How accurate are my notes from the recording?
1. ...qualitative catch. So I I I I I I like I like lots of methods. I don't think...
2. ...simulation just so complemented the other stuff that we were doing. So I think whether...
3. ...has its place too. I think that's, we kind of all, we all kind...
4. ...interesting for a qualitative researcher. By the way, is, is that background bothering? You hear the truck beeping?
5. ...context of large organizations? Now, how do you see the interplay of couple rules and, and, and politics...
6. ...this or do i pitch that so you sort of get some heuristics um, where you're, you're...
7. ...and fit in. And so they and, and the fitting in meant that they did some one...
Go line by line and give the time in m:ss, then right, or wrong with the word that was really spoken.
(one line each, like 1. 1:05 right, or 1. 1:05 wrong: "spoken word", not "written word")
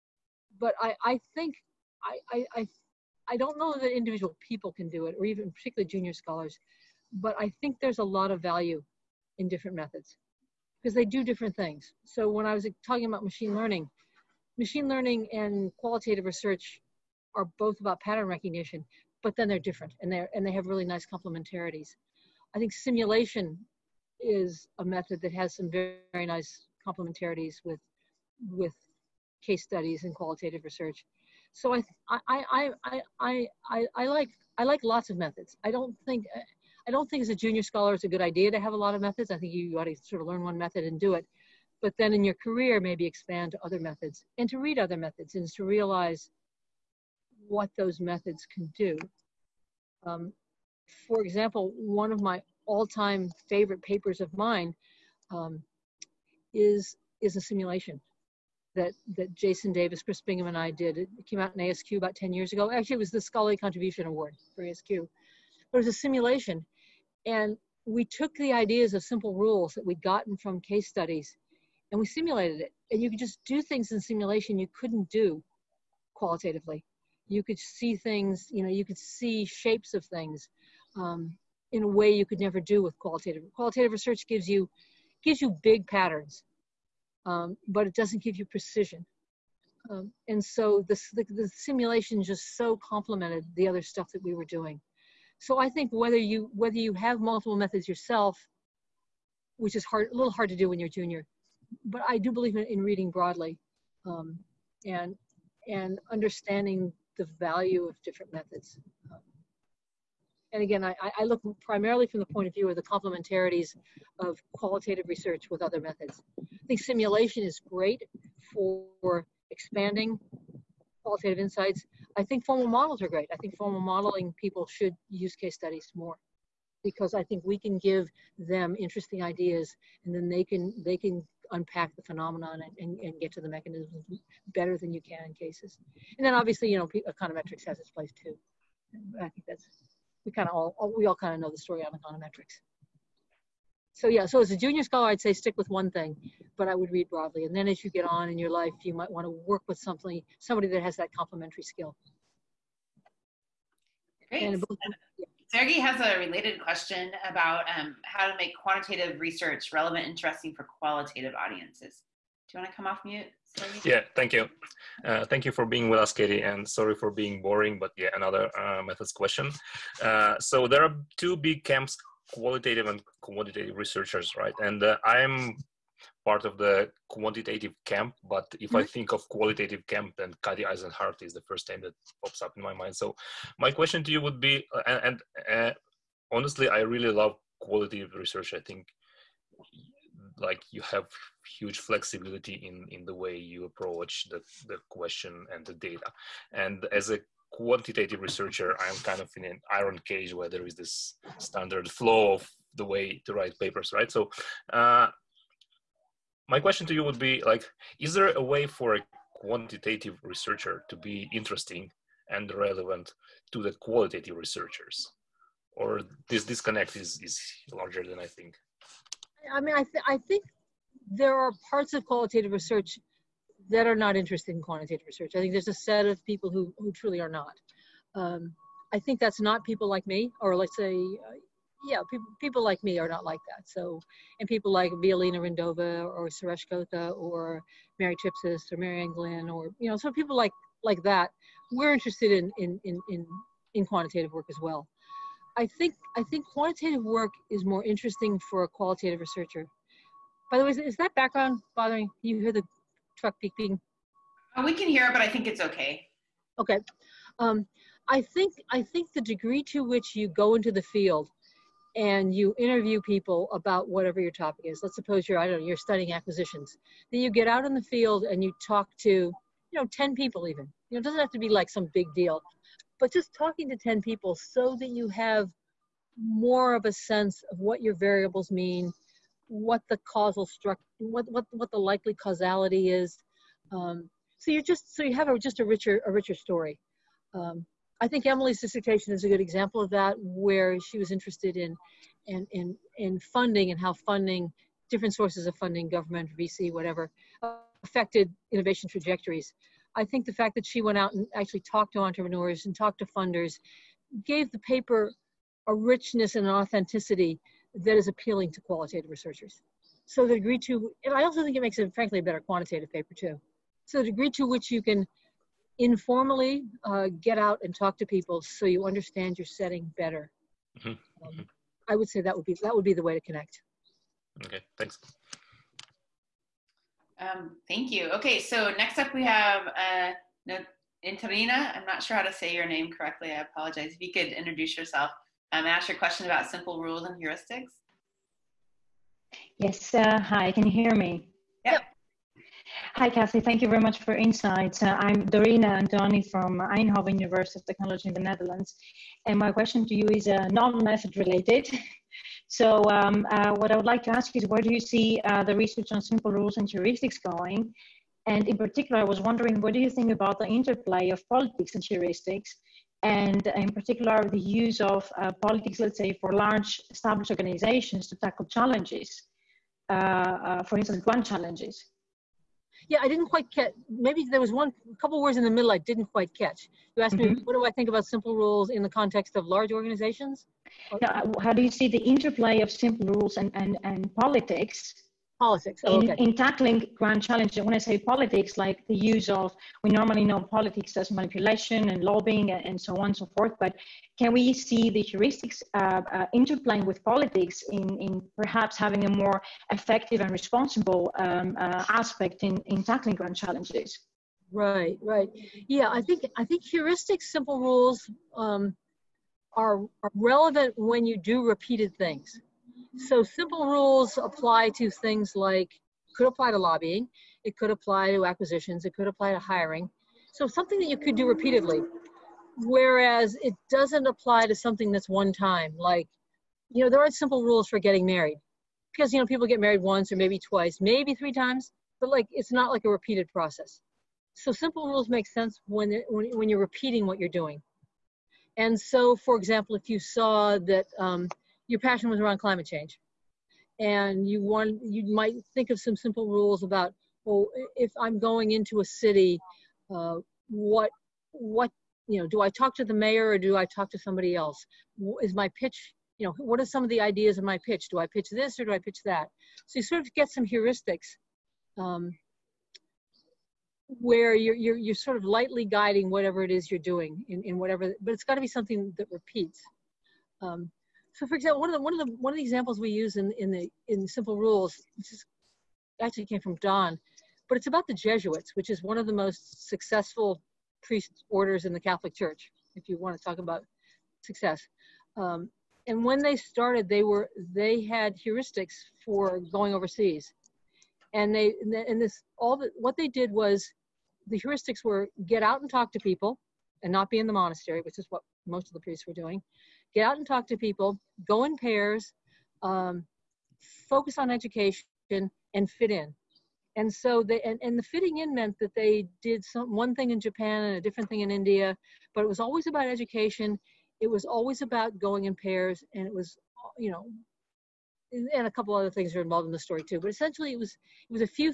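1. 0:30 wrong: "research", not "catch"
2. 1:31 right
3. 2:17 right
4. 4:07 right
5. 6:18 wrong: "simple", not "couple"
6. 7:38 right
7. 8:25 right.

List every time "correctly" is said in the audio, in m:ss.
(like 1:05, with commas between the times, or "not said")
5:32.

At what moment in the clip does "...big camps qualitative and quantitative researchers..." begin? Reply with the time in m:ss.
2:51.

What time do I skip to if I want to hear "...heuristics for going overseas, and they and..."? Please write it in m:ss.
8:08.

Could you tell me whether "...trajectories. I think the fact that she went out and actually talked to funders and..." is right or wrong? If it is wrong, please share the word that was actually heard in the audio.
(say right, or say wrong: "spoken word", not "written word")
wrong: "entrepreneurs", not "funders".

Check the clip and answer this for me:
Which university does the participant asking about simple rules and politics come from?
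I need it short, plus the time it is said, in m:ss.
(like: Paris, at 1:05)
Eindhoven University of Technology, at 5:46.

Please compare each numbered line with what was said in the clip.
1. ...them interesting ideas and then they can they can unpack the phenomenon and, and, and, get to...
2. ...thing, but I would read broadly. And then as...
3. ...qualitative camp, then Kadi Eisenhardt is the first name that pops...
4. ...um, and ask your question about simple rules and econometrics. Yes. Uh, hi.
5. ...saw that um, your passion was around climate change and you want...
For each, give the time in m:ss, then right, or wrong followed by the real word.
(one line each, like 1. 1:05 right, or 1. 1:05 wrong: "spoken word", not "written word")
1. 2:08 right
2. 2:25 right
3. 2:59 right
4. 5:35 wrong: "heuristics", not "econometrics"
5. 7:19 right.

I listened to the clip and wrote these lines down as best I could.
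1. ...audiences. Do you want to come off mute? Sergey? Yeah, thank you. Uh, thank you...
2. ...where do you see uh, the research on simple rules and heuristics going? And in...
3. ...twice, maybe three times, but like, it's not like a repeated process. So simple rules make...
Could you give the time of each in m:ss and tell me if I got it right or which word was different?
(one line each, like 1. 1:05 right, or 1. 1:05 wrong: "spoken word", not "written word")
1. 2:41 right
2. 5:54 right
3. 7:10 right.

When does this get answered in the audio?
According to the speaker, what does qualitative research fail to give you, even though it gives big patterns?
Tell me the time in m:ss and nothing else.
1:28.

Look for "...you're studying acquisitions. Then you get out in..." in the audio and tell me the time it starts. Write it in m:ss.
4:25.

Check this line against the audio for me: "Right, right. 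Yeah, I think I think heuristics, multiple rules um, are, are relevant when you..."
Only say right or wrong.
wrong.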